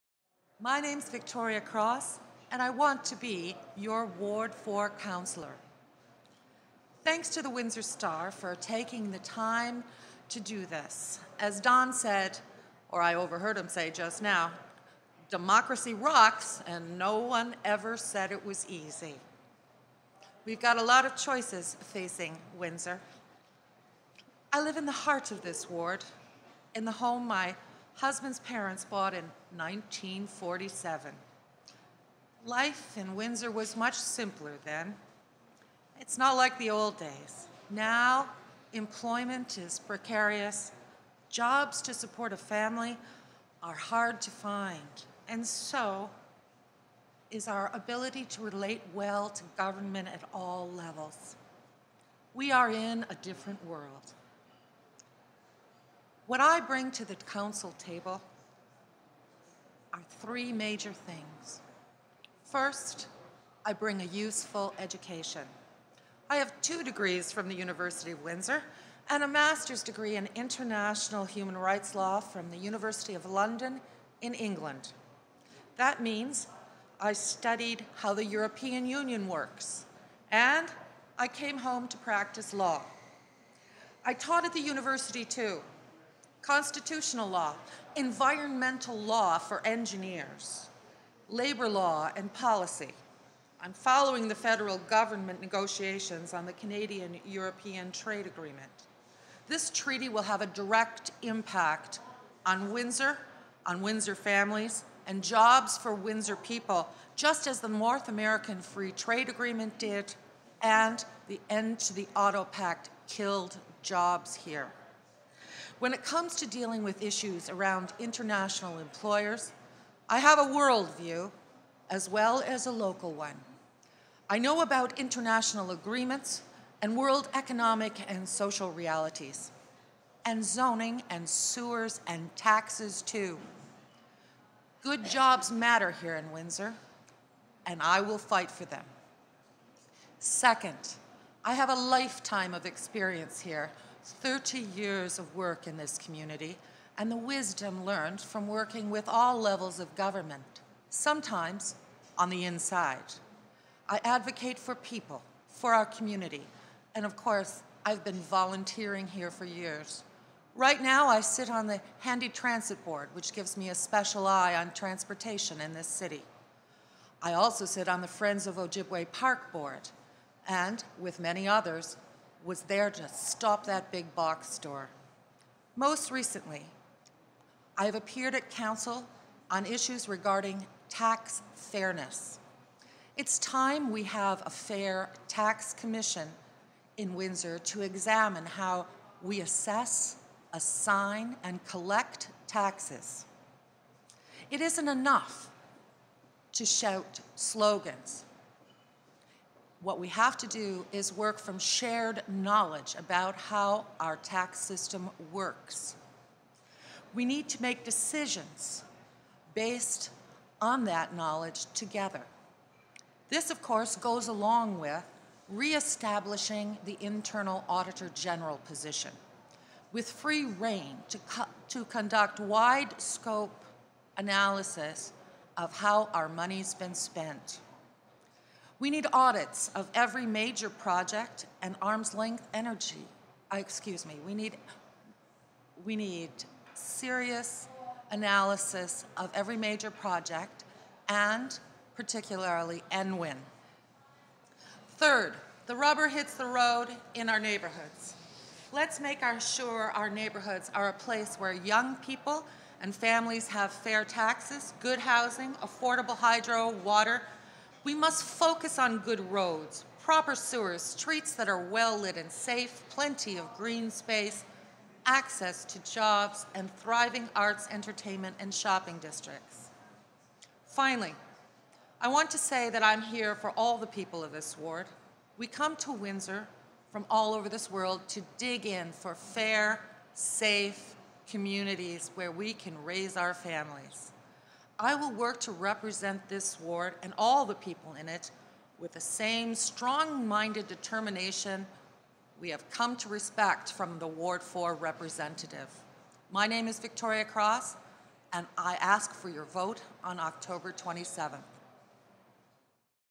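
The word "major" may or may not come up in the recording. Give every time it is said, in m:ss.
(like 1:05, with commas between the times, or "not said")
1:00, 3:50, 3:59.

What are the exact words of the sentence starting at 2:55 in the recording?
Most recently, I have appeared at Council on issues regarding tax fairness.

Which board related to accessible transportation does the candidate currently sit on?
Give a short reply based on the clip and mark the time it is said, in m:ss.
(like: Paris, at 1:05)
Handi Transit Board, at 2:42.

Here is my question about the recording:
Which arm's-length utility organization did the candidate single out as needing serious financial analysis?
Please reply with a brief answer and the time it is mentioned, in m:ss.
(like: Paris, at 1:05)
EnWin, at 4:02.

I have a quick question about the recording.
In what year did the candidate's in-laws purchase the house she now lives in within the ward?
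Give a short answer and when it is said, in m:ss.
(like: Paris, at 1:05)
1947, at 0:29.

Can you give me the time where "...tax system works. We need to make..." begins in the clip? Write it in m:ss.
3:24.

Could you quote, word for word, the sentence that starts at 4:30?
Finally, I want to say that I'm here for all the people of this ward.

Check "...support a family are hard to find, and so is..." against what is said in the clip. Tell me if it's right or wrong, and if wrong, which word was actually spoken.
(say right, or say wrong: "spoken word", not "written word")
right.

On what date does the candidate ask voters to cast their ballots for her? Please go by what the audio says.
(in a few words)
October 27th.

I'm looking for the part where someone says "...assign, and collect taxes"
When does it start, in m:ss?
3:10.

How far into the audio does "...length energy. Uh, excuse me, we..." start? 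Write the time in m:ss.
3:52.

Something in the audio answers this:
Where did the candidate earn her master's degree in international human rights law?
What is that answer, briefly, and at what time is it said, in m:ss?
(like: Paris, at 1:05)
University of London, at 1:12.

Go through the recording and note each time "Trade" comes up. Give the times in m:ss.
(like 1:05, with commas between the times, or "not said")
1:37, 1:48.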